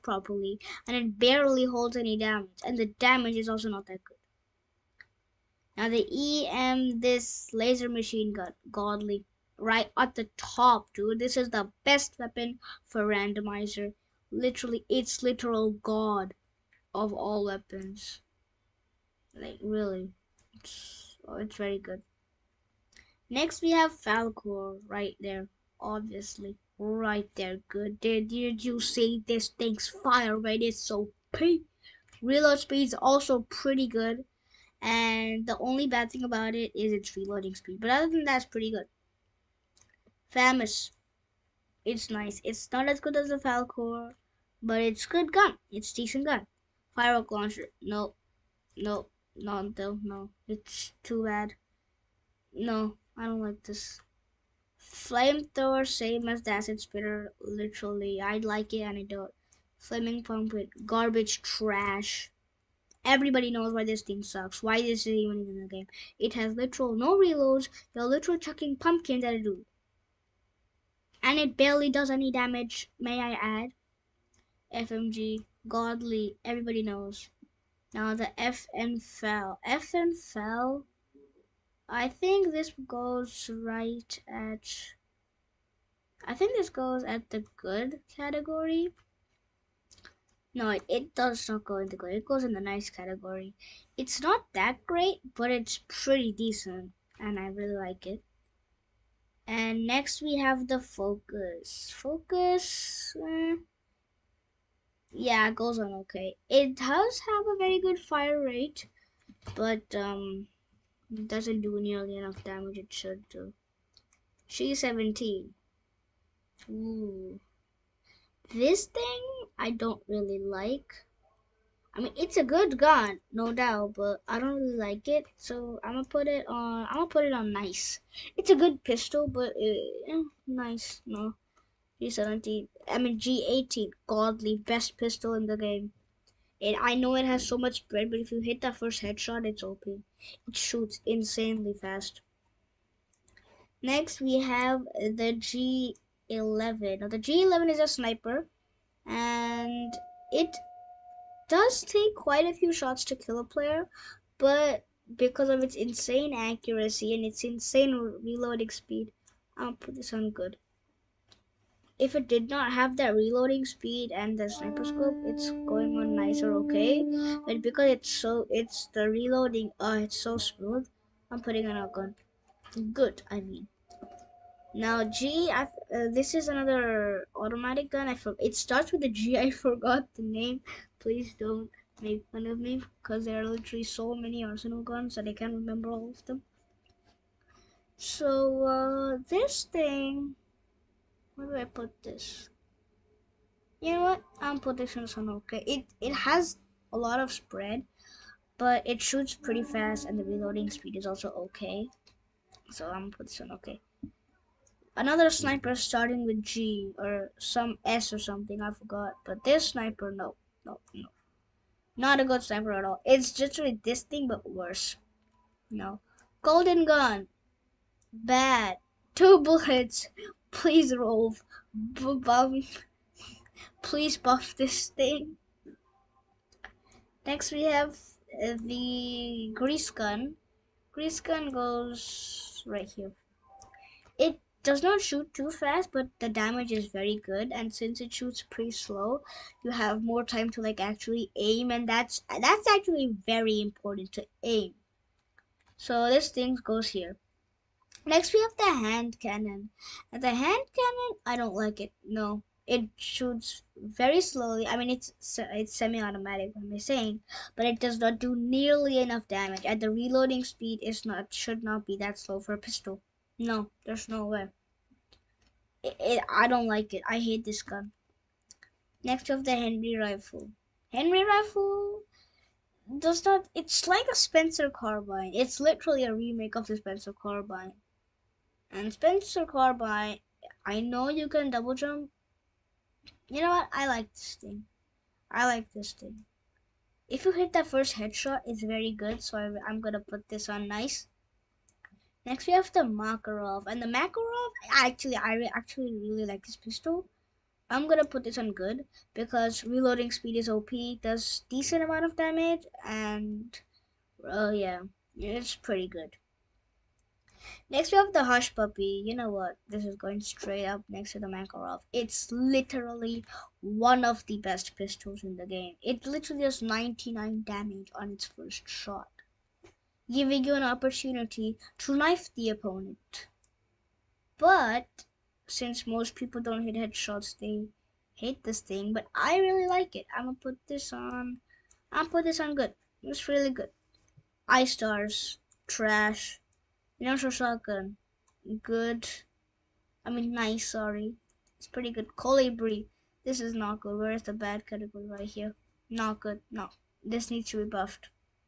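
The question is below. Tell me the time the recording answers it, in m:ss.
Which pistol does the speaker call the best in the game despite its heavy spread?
2:13.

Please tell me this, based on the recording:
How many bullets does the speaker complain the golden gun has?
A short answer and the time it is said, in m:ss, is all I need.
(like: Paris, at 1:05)
2, at 3:39.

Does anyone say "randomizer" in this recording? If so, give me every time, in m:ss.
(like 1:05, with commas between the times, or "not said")
0:13.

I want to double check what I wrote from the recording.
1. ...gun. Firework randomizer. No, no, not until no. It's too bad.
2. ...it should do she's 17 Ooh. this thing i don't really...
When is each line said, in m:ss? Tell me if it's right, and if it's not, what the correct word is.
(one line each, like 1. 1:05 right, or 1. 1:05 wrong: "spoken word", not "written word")
1. 0:46 wrong: "launcher", not "randomizer"
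2. 1:52 right.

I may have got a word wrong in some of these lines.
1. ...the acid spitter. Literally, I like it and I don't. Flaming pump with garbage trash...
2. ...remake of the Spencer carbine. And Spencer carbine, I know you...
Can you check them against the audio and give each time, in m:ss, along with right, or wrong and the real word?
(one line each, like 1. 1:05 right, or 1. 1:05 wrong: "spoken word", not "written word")
1. 0:56 right
2. 4:36 right.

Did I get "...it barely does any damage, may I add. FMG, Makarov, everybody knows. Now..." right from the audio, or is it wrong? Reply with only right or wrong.
wrong.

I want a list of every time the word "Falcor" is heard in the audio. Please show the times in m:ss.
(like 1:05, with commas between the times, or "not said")
0:23, 0:43.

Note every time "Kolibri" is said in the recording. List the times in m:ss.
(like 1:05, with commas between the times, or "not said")
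5:42.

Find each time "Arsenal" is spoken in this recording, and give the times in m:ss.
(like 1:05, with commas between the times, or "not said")
3:04.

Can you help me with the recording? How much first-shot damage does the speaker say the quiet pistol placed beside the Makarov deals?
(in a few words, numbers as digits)
99.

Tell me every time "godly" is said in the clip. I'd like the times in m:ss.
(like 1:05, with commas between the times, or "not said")
0:08, 1:15, 2:14.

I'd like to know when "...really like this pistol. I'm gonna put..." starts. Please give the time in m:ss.
4:55.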